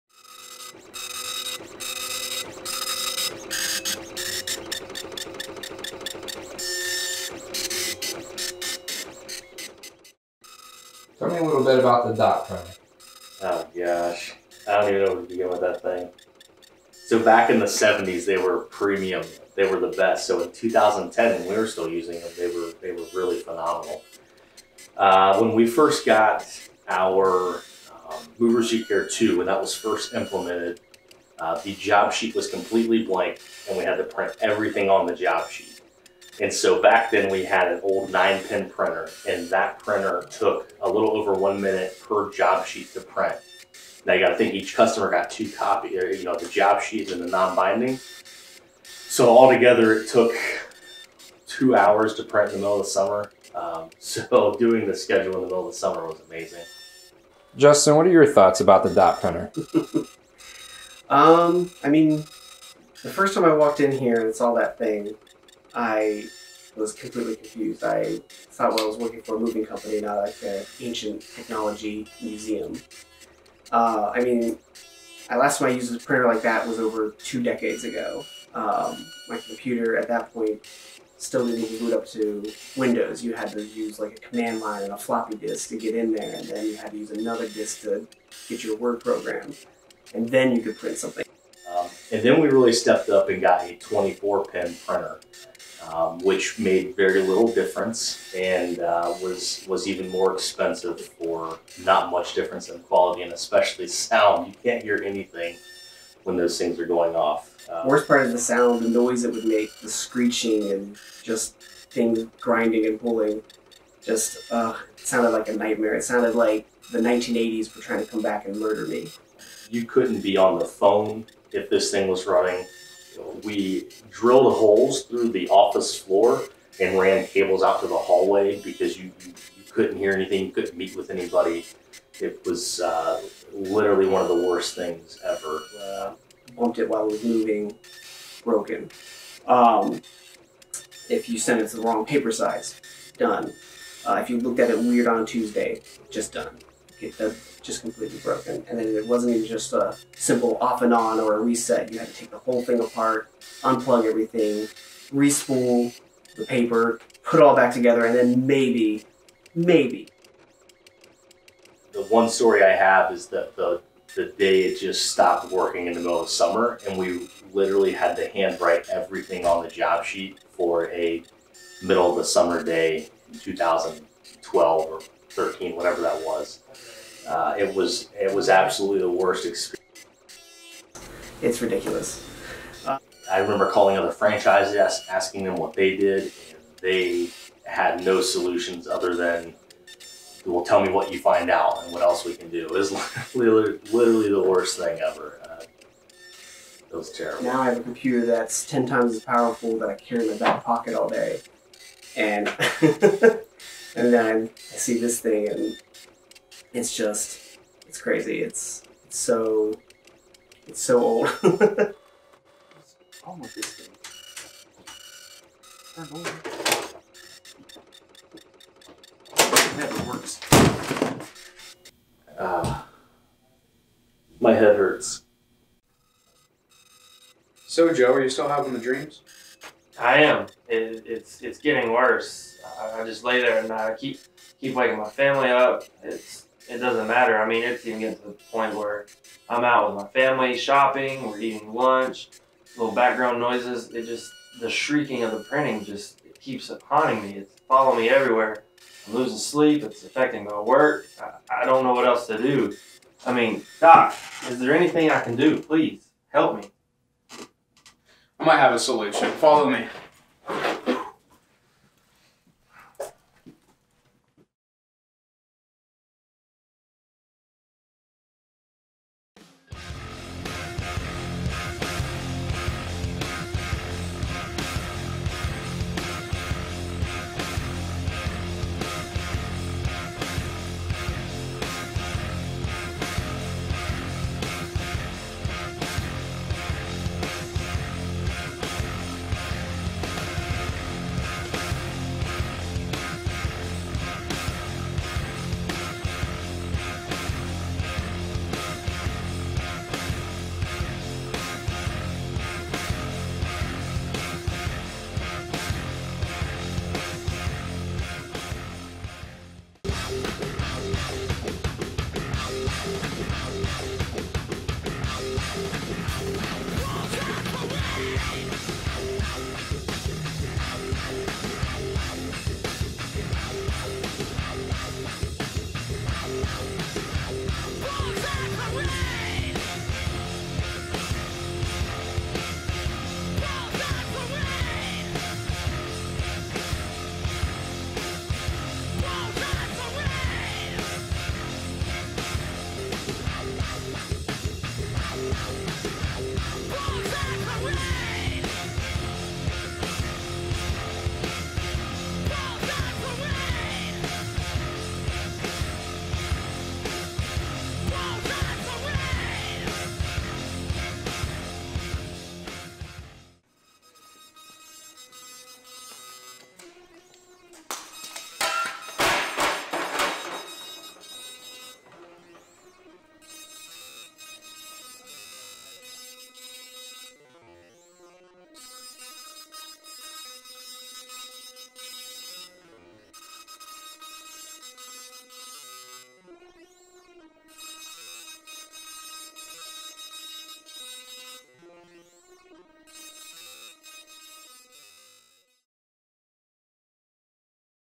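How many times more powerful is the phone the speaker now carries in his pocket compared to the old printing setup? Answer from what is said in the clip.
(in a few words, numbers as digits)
10.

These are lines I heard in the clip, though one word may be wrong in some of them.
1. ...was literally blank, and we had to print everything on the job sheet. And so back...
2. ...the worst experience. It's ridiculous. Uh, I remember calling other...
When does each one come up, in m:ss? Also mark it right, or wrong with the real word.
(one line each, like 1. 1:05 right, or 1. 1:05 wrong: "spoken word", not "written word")
1. 0:32 wrong: "completely", not "literally"
2. 2:58 right.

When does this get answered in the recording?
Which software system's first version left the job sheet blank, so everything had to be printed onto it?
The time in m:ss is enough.
0:28.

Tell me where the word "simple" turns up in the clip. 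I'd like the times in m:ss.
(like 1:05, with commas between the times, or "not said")
2:30.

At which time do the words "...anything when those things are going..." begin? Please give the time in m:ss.
1:45.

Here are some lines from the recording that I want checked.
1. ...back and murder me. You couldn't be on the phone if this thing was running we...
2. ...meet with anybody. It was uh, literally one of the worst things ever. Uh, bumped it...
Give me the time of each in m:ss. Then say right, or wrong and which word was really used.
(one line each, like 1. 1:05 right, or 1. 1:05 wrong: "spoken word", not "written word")
1. 1:58 right
2. 2:10 right.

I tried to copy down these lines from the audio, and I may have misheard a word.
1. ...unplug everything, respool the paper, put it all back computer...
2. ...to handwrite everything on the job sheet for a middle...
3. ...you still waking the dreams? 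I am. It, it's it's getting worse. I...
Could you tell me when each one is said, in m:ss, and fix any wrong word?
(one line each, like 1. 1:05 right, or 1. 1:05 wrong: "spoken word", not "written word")
1. 2:33 wrong: "together", not "computer"
2. 2:48 right
3. 3:48 wrong: "having", not "waking".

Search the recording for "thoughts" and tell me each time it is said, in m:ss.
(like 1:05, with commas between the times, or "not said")
0:58, 1:08.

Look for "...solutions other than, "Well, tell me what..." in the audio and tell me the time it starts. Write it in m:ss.
3:08.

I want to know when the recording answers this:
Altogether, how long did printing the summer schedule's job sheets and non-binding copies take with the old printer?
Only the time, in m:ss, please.
0:51.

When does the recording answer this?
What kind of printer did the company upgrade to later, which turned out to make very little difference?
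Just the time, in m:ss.
1:33.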